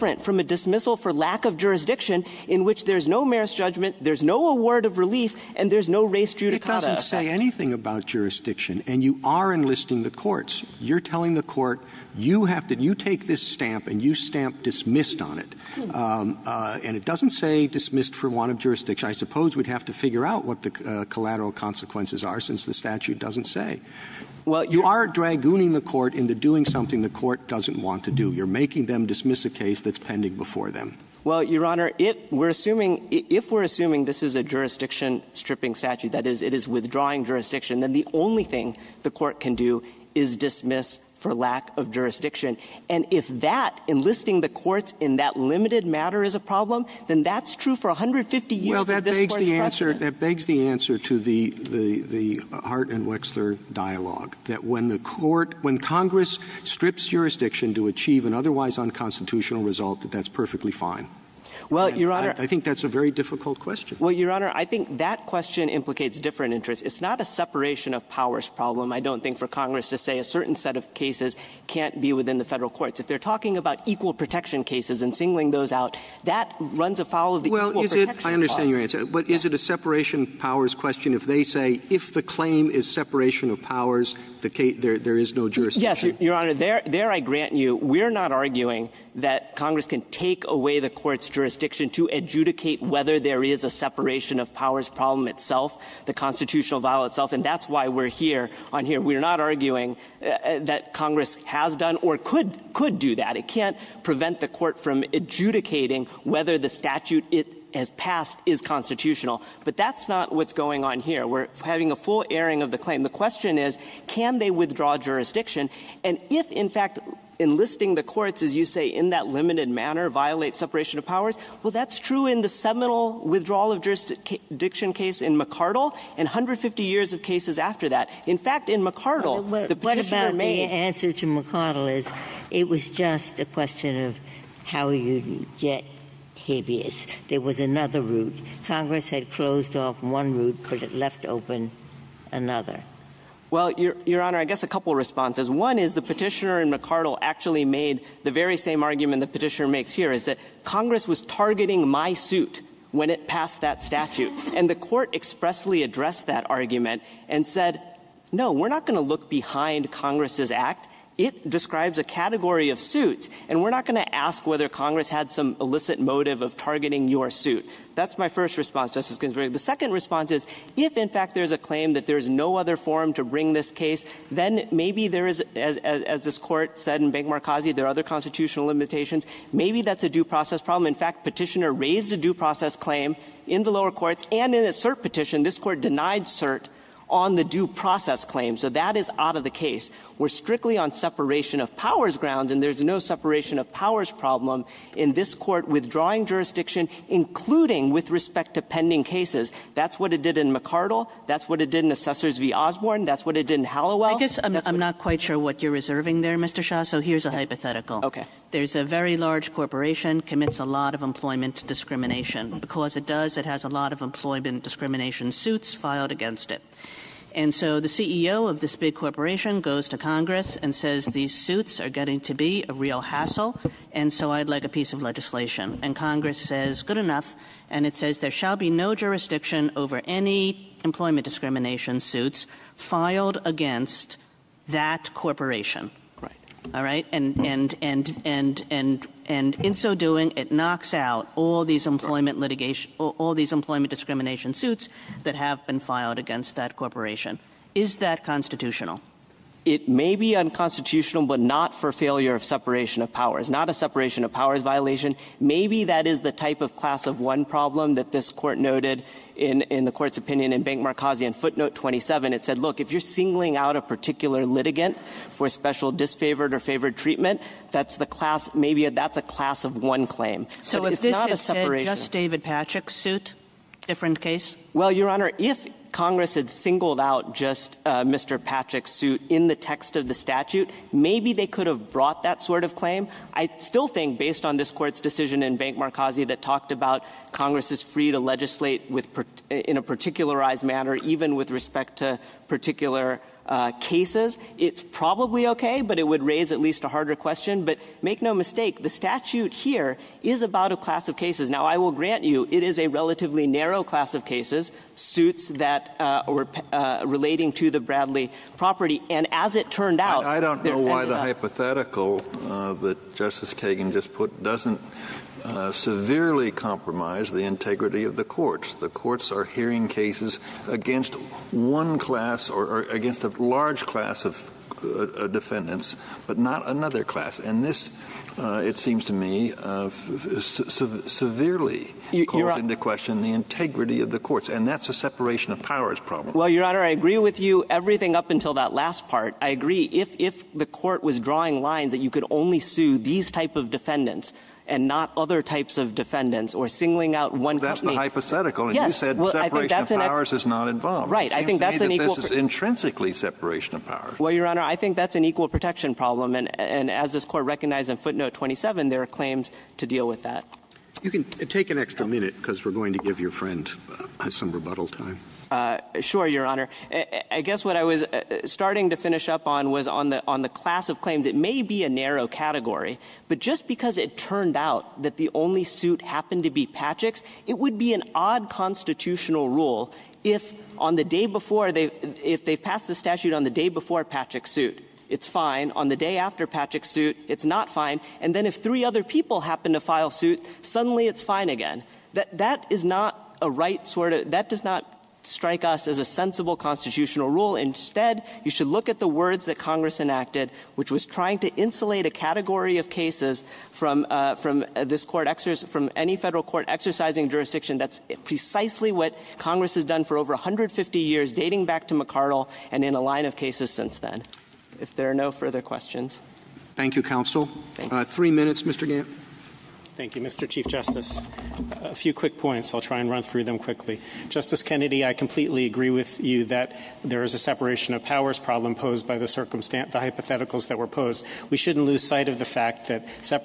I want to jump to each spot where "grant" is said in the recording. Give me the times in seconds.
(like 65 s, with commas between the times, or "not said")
87 s, 301 s.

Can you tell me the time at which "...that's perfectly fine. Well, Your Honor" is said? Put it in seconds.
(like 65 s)
60 s.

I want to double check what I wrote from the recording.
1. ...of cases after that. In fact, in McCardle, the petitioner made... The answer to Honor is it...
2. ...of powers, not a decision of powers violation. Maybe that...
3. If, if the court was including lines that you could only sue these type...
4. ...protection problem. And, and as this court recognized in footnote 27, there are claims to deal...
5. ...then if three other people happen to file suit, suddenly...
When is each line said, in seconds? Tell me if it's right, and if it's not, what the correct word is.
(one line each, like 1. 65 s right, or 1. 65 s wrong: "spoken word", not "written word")
1. 127 s wrong: "McCardle", not "Honor"
2. 253 s wrong: "separation", not "decision"
3. 339 s wrong: "drawing", not "including"
4. 355 s right
5. 388 s right.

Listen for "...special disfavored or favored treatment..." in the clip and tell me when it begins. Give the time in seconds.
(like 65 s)
265 s.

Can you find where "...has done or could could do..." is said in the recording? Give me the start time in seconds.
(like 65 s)
101 s.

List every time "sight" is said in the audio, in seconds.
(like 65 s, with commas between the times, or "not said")
432 s.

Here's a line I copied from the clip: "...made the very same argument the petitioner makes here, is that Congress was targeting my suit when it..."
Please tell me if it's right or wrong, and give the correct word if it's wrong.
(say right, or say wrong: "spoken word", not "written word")
right.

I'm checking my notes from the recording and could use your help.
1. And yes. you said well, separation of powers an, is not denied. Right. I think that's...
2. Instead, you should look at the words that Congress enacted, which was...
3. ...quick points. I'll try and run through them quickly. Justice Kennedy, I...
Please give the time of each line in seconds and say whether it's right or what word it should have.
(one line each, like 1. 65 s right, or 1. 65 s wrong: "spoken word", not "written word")
1. 348 s wrong: "involved", not "denied"
2. 397 s right
3. 422 s right.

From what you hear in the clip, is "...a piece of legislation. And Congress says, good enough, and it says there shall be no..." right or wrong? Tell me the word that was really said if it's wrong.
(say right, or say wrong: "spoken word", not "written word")
right.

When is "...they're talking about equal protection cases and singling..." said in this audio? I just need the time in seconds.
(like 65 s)
73 s.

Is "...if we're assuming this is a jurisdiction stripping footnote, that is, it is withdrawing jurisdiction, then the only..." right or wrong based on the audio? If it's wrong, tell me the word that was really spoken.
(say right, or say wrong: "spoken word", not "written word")
wrong: "statute", not "footnote".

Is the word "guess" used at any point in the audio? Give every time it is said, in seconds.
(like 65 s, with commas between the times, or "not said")
144 s, 204 s, 367 s.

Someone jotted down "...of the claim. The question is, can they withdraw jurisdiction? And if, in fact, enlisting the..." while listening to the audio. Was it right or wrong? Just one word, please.
right.